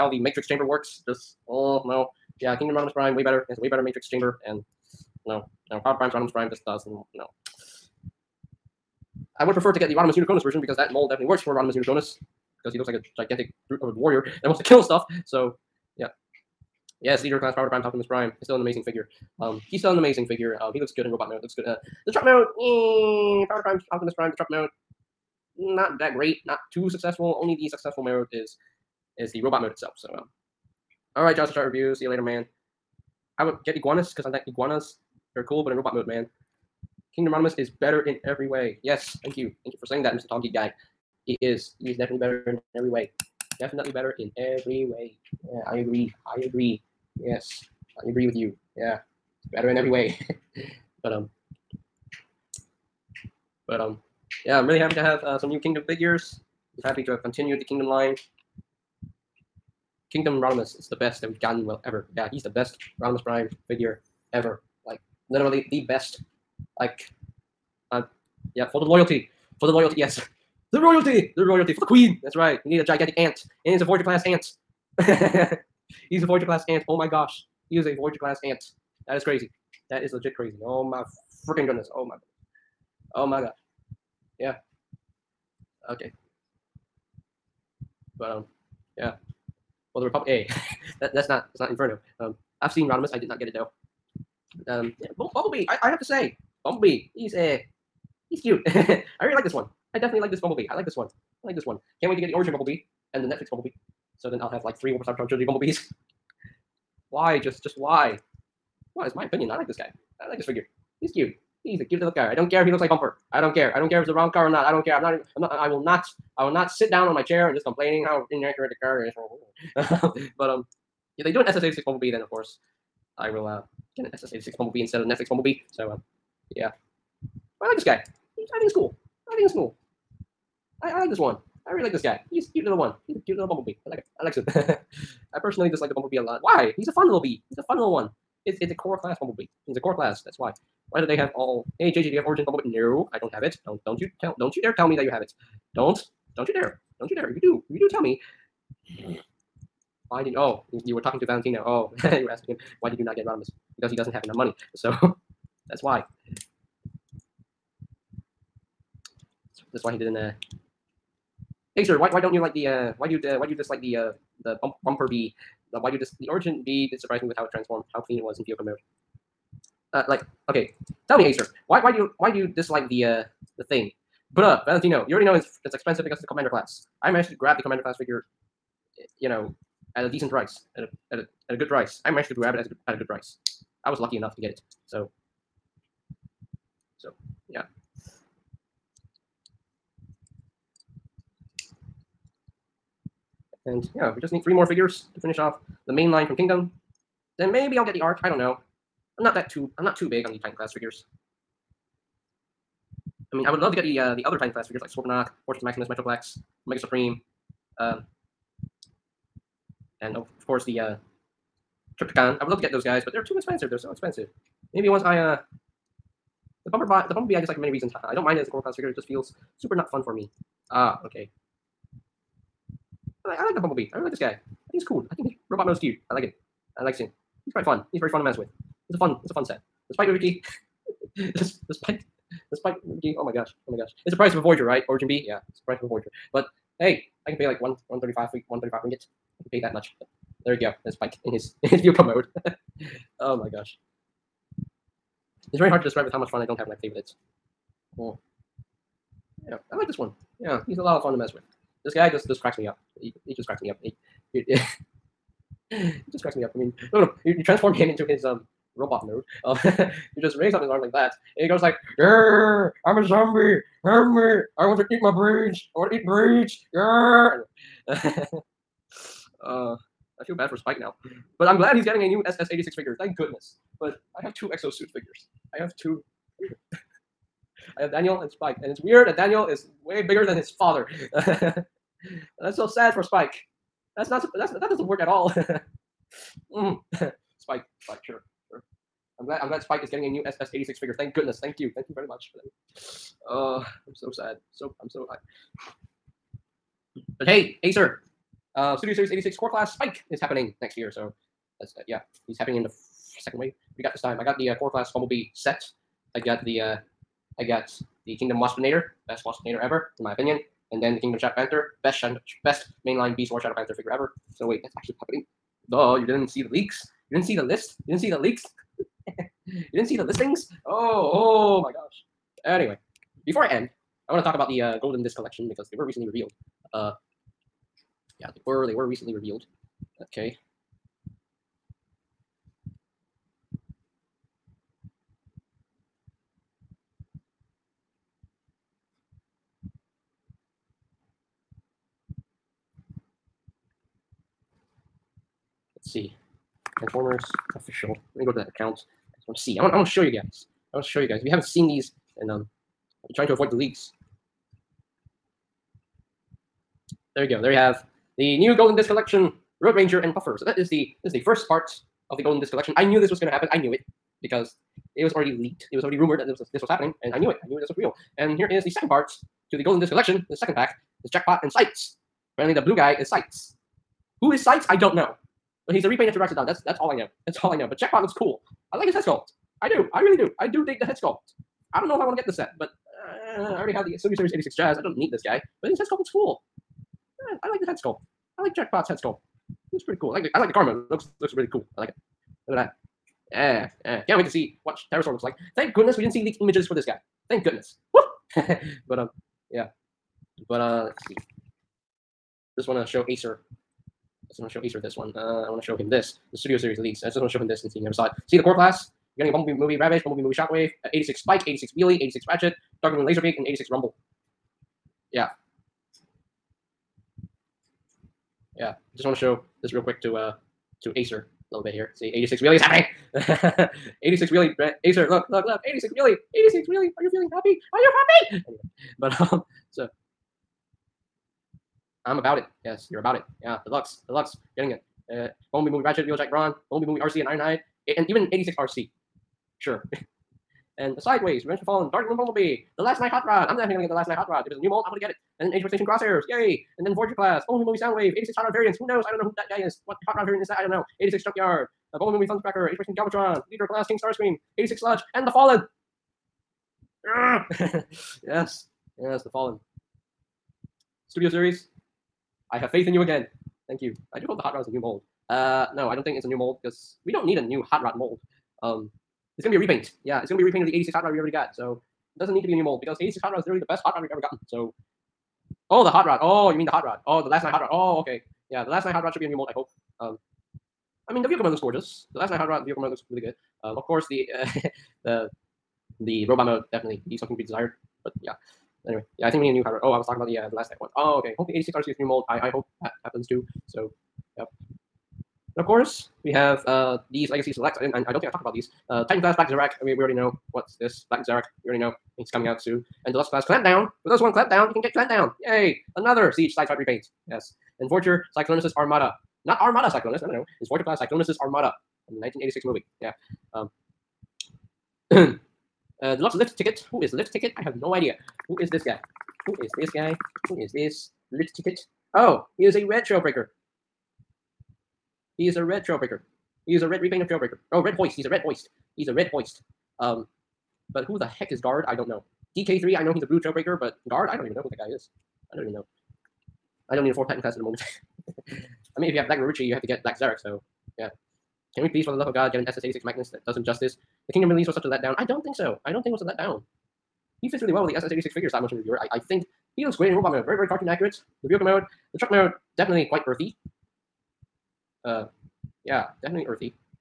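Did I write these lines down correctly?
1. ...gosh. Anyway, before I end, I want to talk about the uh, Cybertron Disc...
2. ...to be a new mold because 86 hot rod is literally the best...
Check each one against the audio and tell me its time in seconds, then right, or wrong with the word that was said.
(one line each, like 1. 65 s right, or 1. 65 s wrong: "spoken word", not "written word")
1. 321 s wrong: "Golden", not "Cybertron"
2. 472 s right.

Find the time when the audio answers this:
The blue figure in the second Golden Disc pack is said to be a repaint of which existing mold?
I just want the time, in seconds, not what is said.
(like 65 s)
376 s.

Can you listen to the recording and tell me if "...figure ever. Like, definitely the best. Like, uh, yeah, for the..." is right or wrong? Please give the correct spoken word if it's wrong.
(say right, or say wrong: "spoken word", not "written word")
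wrong: "literally", not "definitely".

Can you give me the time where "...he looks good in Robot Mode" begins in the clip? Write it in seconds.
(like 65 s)
20 s.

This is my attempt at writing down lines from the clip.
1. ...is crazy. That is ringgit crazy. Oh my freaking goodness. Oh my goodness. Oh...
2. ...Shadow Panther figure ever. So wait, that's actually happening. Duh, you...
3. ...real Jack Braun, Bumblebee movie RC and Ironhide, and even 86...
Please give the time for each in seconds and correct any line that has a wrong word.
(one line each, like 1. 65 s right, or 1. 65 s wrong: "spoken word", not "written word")
1. 79 s wrong: "legit", not "ringgit"
2. 313 s right
3. 436 s right.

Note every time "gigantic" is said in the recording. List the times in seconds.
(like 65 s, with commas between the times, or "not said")
13 s, 72 s.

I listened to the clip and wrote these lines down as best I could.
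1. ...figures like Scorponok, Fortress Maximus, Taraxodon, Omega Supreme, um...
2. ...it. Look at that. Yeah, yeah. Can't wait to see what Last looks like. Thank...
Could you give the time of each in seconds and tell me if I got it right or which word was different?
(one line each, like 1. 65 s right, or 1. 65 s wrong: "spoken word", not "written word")
1. 204 s wrong: "Metroplex", not "Taraxodon"
2. 391 s wrong: "Terrorsaur", not "Last".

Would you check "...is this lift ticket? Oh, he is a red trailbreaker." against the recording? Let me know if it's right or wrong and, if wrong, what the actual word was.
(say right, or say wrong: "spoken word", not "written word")
right.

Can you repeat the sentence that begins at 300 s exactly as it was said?
So that's, uh, yeah, he's happening in the second wave.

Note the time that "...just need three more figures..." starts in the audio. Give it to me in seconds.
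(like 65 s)
194 s.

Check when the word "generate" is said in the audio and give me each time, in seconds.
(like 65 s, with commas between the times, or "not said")
not said.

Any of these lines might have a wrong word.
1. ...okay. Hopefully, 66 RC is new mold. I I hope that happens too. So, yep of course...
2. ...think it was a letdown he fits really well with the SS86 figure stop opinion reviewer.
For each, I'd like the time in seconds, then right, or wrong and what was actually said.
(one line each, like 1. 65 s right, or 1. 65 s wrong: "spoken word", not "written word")
1. 491 s wrong: "86", not "66"
2. 546 s wrong: "motion", not "opinion".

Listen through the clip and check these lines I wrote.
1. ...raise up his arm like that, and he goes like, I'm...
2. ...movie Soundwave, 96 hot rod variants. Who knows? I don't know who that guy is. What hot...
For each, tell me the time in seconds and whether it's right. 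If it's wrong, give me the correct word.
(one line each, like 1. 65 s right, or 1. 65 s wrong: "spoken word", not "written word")
1. 260 s right
2. 447 s wrong: "86", not "96".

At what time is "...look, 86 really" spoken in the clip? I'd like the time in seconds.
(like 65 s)
425 s.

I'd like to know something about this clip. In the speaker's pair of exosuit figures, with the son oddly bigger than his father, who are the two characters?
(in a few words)
Daniel and Spike.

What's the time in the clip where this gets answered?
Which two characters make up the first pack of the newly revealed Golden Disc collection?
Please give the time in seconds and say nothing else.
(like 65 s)
359 s.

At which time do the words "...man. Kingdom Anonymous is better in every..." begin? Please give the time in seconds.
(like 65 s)
36 s.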